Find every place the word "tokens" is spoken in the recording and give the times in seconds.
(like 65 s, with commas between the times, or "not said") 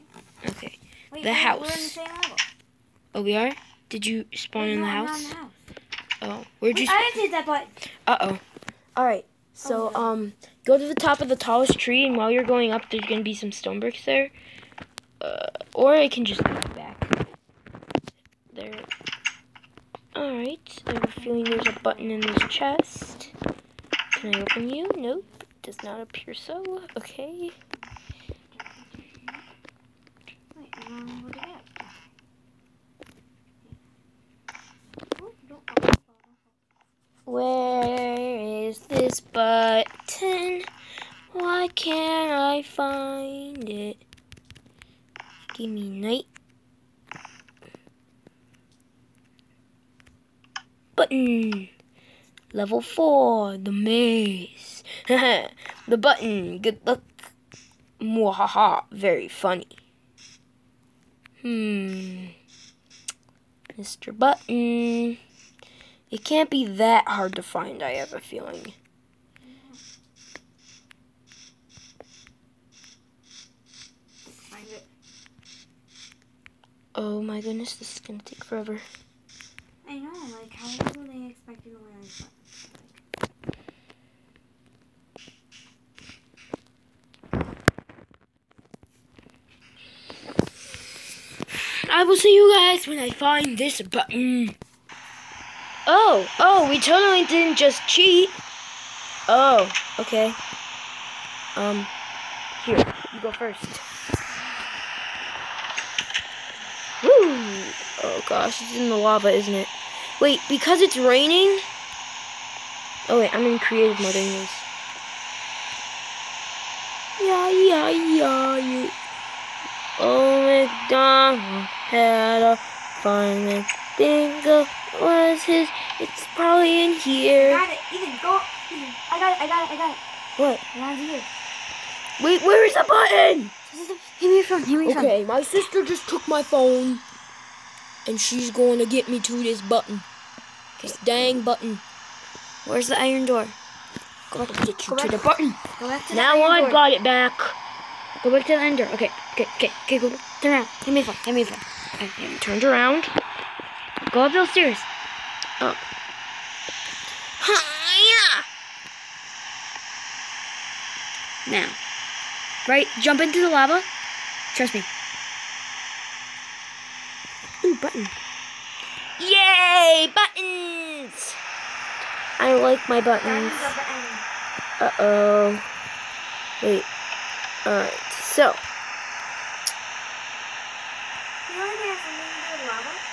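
not said.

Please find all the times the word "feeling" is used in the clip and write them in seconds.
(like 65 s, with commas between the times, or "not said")
21 s, 68 s.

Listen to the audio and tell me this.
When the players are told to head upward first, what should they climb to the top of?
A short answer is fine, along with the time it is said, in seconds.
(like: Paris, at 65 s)
The tallest tree, at 11 s.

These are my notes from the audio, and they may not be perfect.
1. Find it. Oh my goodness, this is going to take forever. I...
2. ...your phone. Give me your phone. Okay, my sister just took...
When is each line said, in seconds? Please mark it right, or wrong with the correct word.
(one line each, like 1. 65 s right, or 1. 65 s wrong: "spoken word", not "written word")
1. 74 s right
2. 134 s right.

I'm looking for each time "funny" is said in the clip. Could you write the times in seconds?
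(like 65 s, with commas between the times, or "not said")
59 s.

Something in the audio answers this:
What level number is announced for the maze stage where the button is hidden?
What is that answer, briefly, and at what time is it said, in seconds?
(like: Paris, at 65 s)
4, at 52 s.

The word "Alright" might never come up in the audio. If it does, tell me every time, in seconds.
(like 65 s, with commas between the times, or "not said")
20 s, 177 s.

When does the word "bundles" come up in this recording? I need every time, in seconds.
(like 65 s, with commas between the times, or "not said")
not said.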